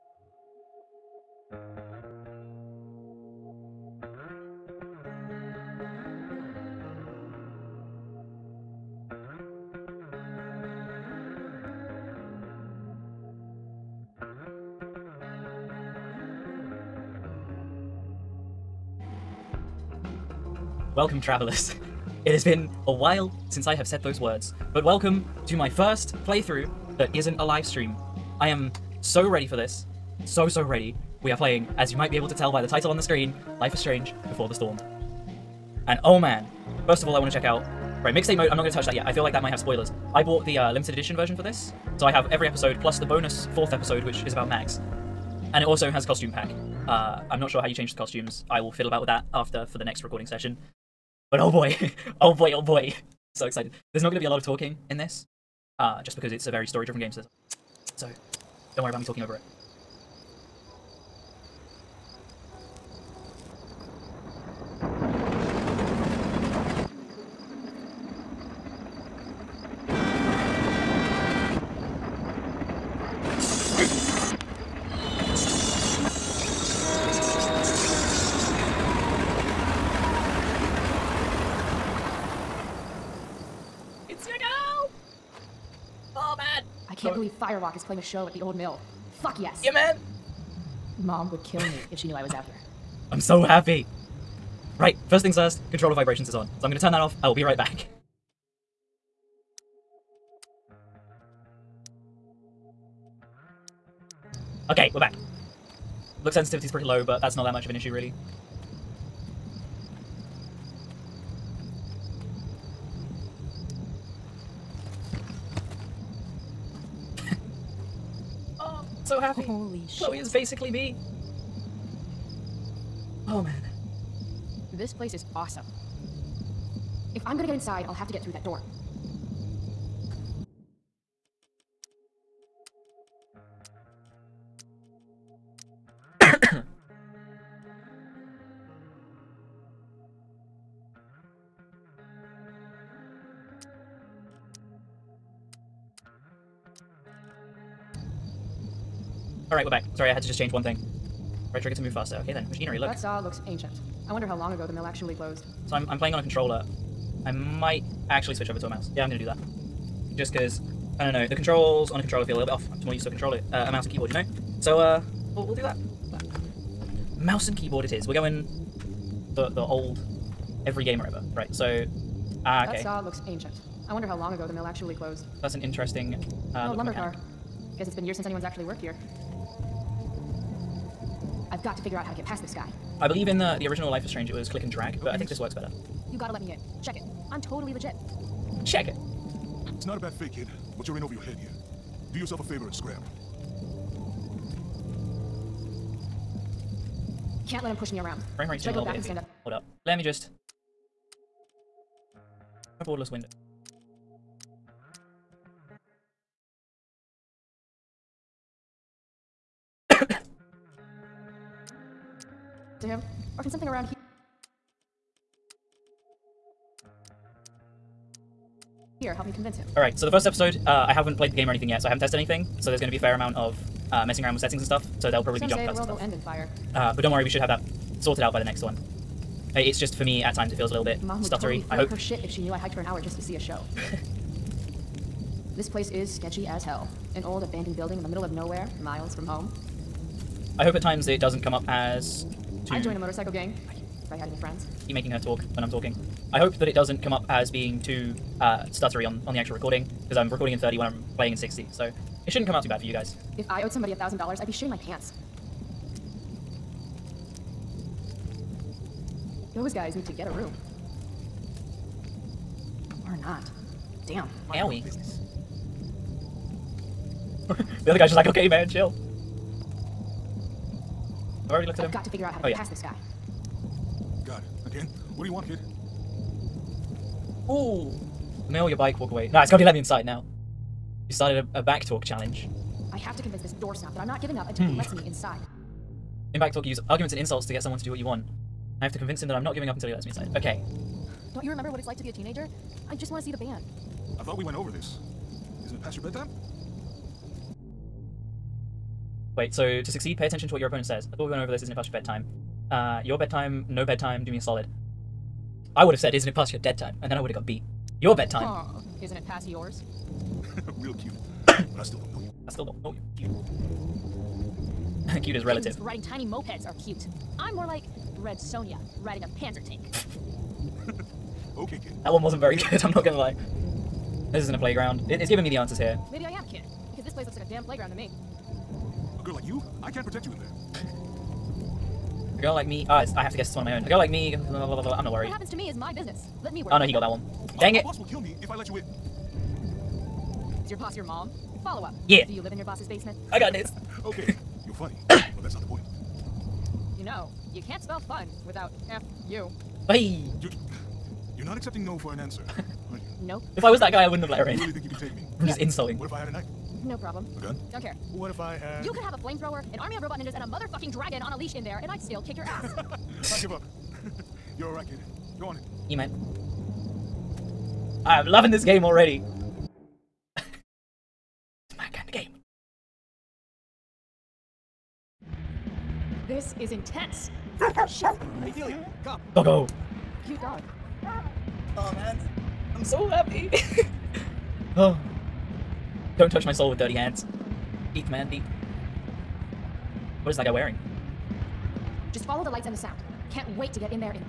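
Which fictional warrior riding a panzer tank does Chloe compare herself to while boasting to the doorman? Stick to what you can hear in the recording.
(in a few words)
Red Sonja.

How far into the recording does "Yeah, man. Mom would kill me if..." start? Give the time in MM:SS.
01:29.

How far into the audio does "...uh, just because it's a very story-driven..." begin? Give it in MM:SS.
00:55.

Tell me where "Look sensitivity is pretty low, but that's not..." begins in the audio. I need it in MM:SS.
01:46.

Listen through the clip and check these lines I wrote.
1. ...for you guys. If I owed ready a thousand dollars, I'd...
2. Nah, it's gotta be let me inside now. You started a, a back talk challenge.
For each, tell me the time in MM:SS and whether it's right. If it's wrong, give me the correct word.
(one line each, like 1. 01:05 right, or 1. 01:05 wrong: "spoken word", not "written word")
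1. 04:12 wrong: "somebody", not "ready"
2. 04:39 right.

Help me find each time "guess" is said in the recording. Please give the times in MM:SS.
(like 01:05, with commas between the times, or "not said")
02:57, 05:33.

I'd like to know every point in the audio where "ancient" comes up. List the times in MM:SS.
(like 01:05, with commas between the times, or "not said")
02:33, 02:53.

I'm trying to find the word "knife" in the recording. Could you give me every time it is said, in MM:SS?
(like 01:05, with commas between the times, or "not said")
05:56.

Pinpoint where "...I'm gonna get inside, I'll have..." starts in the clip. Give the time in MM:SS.
02:07.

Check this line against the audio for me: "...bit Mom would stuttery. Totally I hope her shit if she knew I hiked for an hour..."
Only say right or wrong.
right.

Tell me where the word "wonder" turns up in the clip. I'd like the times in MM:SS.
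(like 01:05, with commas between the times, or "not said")
02:34, 02:53.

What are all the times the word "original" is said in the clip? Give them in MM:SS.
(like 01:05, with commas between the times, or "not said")
03:03.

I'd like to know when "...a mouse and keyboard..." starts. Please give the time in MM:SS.
02:43.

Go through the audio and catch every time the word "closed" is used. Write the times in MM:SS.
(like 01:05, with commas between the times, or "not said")
02:35, 02:54.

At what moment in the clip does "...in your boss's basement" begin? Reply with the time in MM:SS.
05:42.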